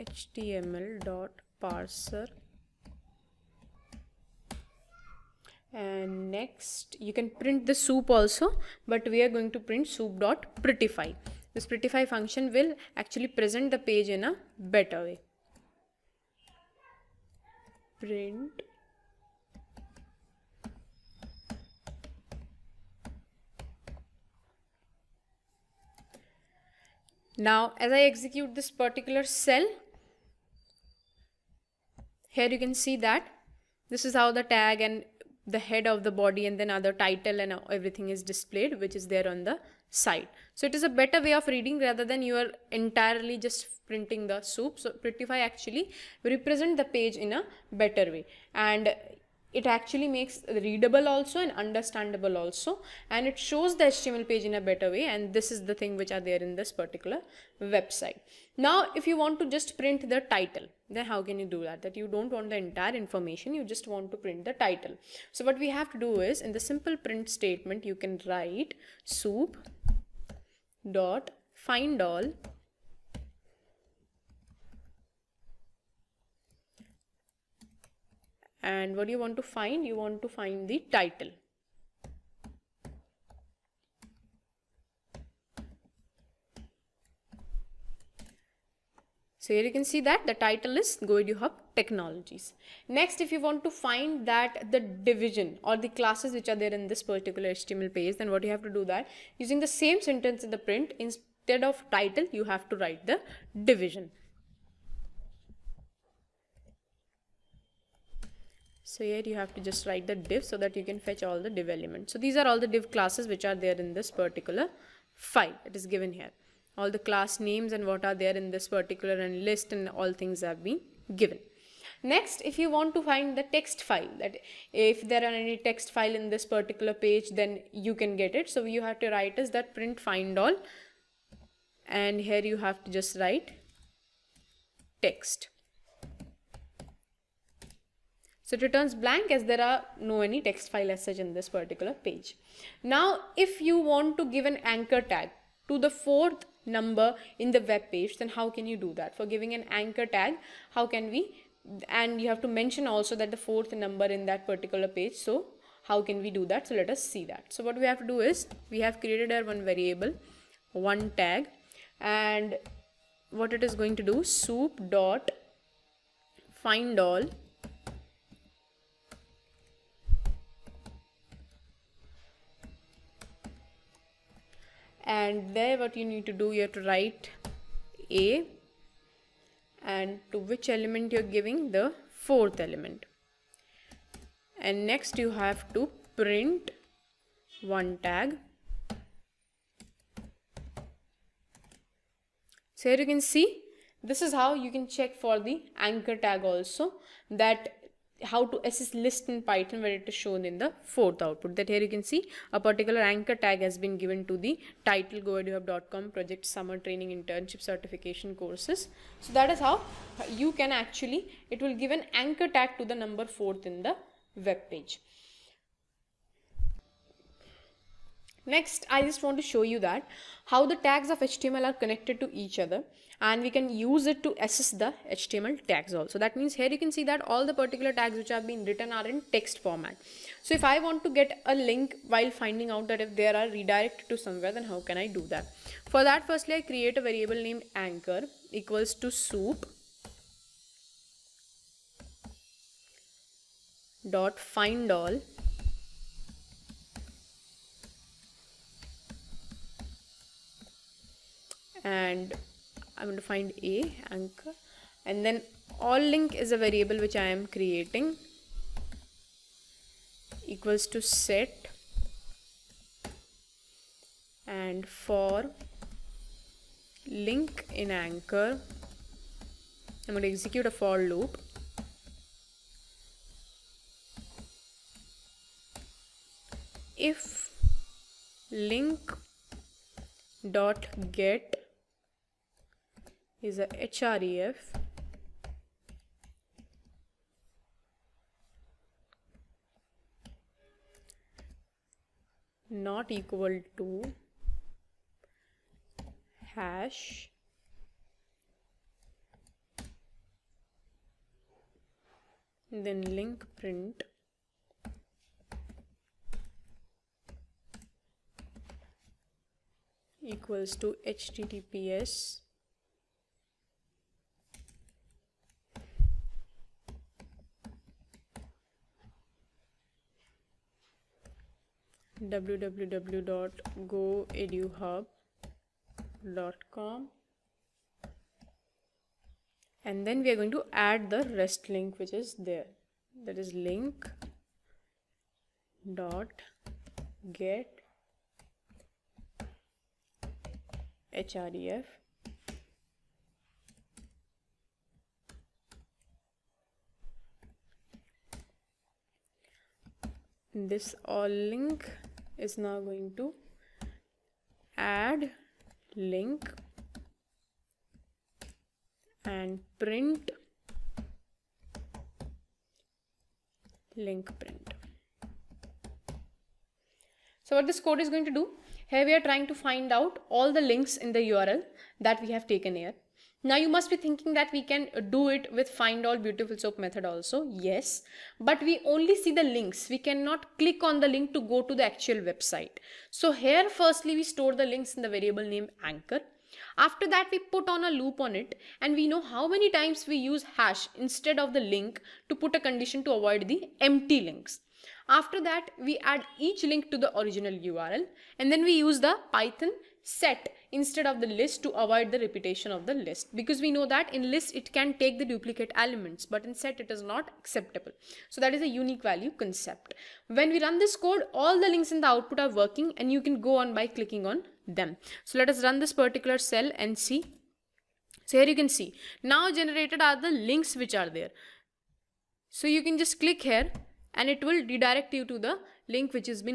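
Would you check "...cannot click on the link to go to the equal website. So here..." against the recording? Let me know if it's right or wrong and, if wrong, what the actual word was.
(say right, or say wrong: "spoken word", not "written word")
wrong: "actual", not "equal".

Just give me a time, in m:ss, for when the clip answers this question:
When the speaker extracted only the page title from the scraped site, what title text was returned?
1:31.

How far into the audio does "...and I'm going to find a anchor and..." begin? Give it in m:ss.
4:11.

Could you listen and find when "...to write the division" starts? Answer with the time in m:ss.
1:42.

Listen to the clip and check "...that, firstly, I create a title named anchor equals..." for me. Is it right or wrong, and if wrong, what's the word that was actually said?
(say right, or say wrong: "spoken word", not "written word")
wrong: "variable", not "title".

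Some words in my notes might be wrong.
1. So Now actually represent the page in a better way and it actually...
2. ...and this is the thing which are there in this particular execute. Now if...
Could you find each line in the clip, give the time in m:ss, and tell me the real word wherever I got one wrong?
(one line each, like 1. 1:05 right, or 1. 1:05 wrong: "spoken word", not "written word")
1. 0:44 wrong: "Prettify", not "Now"
2. 0:55 wrong: "website", not "execute".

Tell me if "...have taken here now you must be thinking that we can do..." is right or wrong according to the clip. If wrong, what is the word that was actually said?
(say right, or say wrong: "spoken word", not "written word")
right.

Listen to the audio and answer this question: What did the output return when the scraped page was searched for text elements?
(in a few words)
blank.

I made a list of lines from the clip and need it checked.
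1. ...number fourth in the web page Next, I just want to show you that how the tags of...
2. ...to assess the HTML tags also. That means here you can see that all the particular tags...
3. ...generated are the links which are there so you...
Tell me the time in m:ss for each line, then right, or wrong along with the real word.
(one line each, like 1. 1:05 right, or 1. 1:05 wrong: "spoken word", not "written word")
1. 3:33 right
2. 3:44 right
3. 6:59 right.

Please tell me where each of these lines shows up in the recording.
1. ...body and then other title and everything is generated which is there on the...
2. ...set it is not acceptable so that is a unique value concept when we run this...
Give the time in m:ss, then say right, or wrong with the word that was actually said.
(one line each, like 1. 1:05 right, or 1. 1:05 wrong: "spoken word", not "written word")
1. 0:36 wrong: "displayed", not "generated"
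2. 6:46 right.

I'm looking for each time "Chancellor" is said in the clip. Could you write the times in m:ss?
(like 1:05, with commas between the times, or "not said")
not said.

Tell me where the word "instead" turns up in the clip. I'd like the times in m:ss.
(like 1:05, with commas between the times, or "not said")
1:40, 6:30, 6:40.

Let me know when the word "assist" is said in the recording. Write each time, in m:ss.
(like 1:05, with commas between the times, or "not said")
3:18.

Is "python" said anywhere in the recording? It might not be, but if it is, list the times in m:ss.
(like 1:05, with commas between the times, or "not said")
3:19, 6:39.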